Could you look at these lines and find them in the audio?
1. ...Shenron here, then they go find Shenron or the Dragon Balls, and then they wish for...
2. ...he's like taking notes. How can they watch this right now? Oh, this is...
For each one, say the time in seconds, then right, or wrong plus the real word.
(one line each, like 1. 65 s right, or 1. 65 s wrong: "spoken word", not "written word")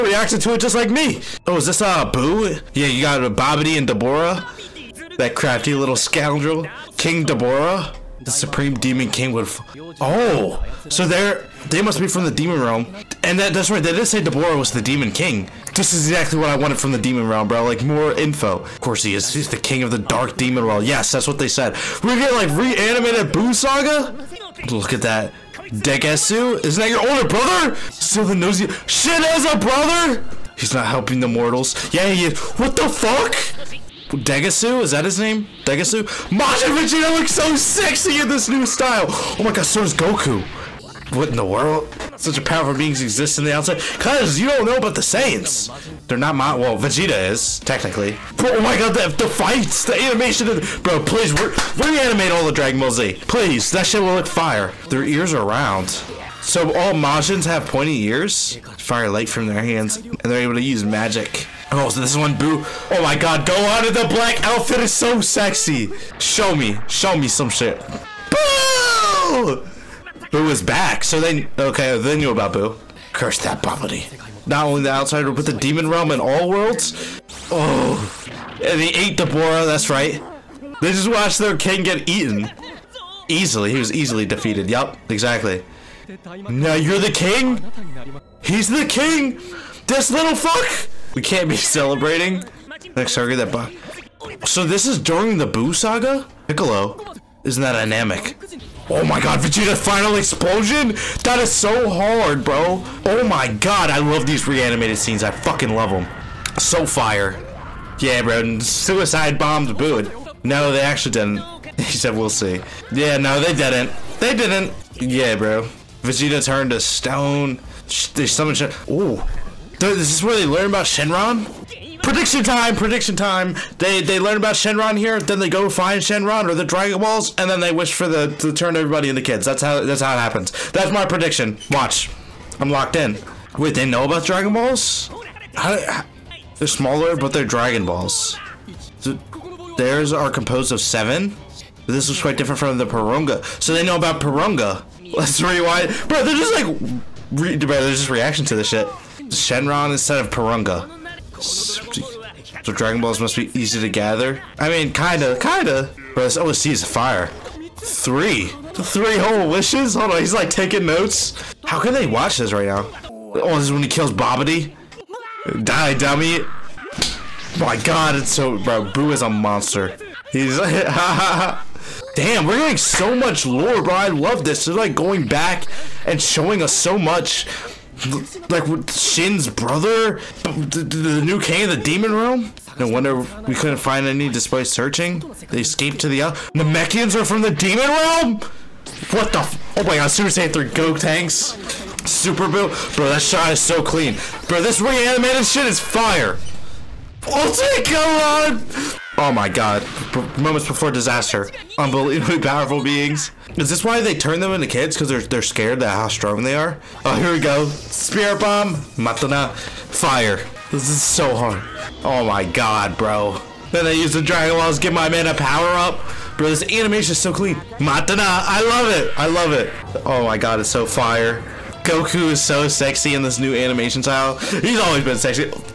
1. 124 s right
2. 160 s right.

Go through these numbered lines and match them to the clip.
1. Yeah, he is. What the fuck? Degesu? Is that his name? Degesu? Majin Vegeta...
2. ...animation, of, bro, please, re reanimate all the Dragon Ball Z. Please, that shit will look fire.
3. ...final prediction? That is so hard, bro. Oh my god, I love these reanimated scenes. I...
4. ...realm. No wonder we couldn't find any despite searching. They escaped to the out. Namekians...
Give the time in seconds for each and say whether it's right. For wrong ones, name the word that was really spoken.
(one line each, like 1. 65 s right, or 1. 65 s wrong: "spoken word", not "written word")
1. 31 s right
2. 49 s right
3. 99 s wrong: "explosion", not "prediction"
4. 182 s right.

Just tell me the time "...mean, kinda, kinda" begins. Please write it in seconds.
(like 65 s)
154 s.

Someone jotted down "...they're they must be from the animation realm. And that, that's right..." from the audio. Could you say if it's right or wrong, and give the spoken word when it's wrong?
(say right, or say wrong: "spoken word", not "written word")
wrong: "demon", not "animation".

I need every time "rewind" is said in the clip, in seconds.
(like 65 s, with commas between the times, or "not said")
145 s.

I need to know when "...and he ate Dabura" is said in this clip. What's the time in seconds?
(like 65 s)
78 s.